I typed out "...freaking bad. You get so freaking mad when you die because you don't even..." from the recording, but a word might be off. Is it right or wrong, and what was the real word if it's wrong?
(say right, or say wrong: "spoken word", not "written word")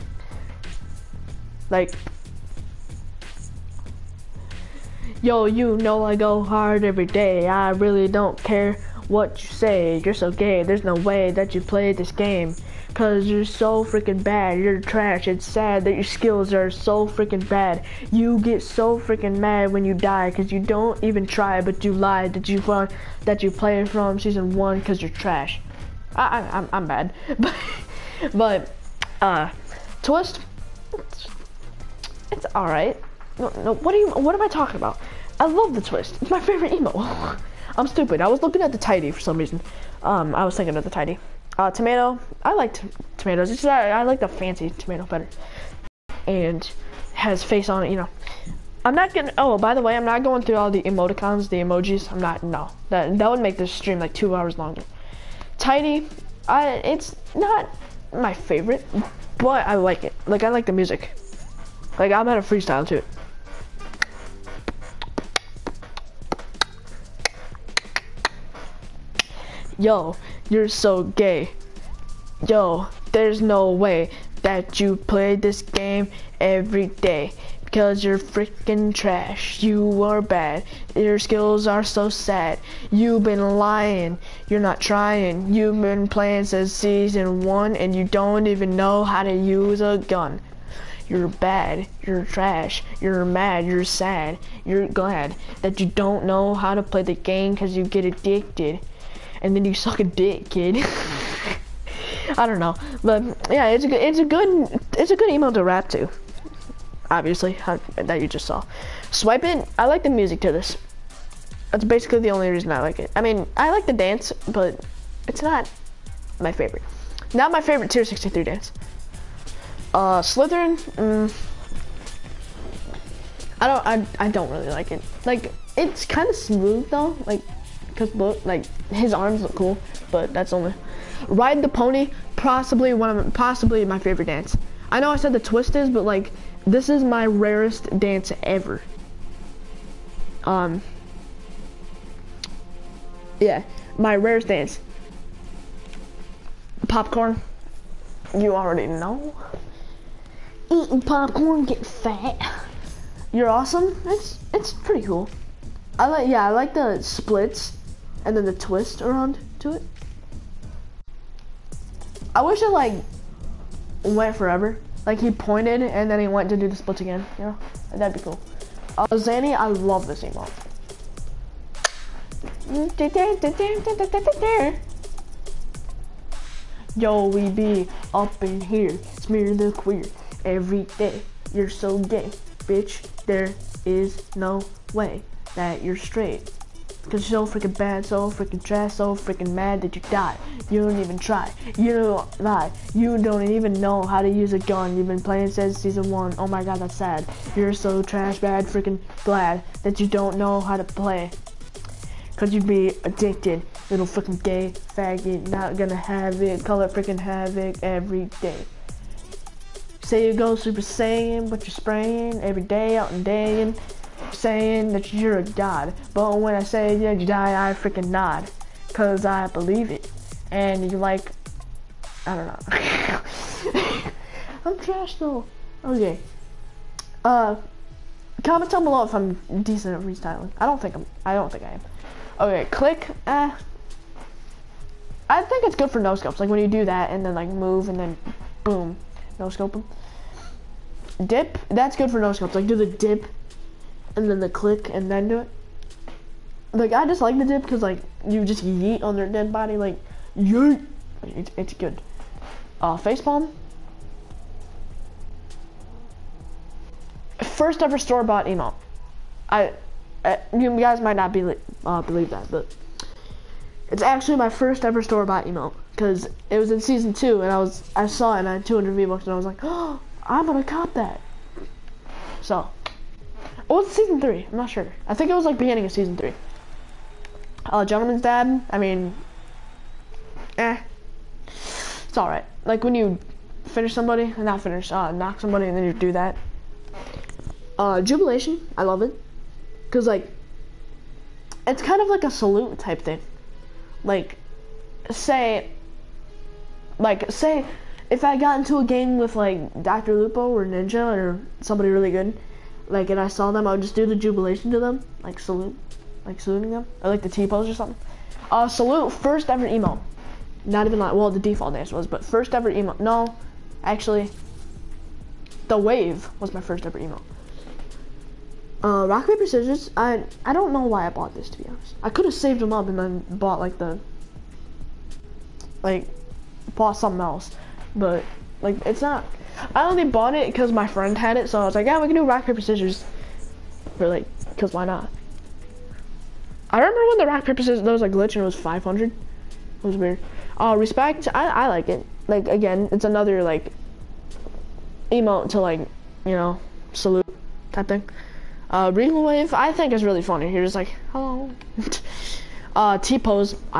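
right.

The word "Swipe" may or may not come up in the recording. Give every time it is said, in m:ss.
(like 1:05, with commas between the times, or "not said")
1:49.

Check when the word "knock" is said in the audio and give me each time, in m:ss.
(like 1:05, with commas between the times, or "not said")
4:45.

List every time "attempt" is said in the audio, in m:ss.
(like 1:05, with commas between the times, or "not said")
not said.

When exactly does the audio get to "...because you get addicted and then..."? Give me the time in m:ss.
1:37.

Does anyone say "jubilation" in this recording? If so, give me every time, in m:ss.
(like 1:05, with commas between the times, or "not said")
4:48, 5:04.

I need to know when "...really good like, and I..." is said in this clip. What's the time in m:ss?
5:01.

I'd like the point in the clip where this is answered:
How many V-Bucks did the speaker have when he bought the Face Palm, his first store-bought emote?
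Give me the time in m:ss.
4:28.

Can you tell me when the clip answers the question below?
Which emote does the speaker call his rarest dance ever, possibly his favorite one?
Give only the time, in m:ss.
2:11.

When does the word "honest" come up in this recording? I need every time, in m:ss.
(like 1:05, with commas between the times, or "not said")
5:21.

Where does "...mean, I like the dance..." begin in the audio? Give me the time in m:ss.
1:53.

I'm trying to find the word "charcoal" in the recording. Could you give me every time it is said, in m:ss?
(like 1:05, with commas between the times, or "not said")
not said.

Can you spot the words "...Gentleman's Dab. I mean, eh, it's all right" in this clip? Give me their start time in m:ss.
4:37.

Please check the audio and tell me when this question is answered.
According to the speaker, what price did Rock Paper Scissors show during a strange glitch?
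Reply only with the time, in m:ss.
5:38.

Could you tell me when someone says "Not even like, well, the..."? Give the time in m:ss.
5:10.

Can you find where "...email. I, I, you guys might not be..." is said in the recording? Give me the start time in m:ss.
4:18.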